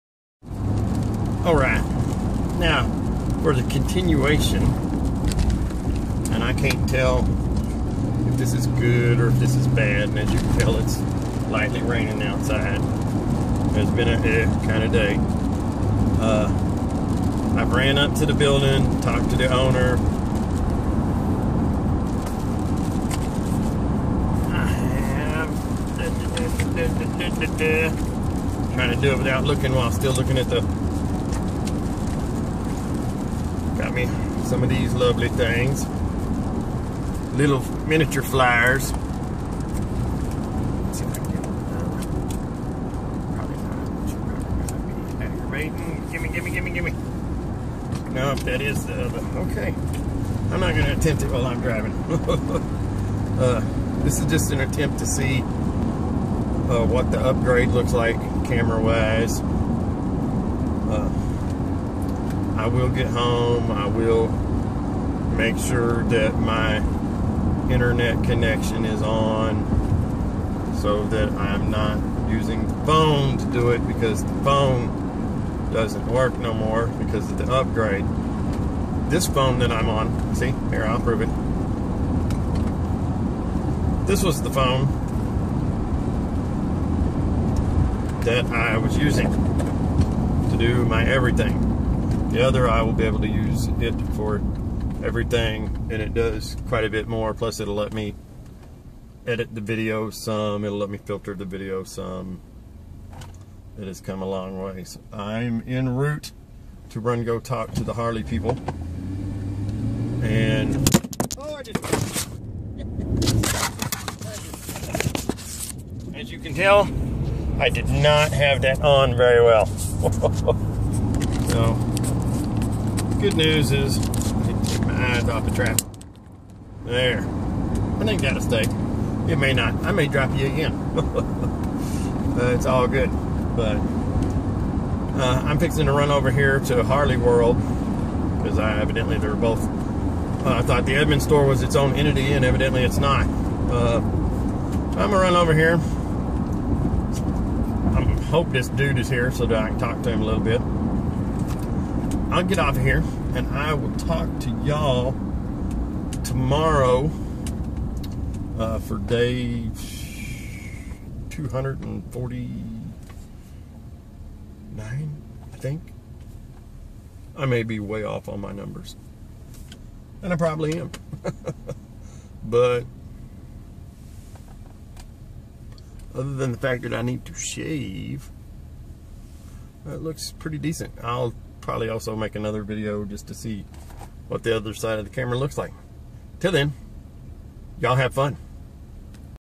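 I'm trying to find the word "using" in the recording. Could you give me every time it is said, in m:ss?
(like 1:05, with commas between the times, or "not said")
1:12, 1:28.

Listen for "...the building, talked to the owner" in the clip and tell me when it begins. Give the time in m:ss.
0:18.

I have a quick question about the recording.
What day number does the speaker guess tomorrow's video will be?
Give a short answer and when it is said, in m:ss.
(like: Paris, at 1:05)
249, at 2:41.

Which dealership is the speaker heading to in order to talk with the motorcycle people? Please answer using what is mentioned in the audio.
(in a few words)
Harley World.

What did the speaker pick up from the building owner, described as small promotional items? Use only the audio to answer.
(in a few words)
Little miniature flyers.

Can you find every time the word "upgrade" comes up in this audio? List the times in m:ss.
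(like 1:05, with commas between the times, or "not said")
0:57, 1:17.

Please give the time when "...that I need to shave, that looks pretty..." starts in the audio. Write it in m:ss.
2:56.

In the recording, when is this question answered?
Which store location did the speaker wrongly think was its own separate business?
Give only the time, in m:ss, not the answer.
2:20.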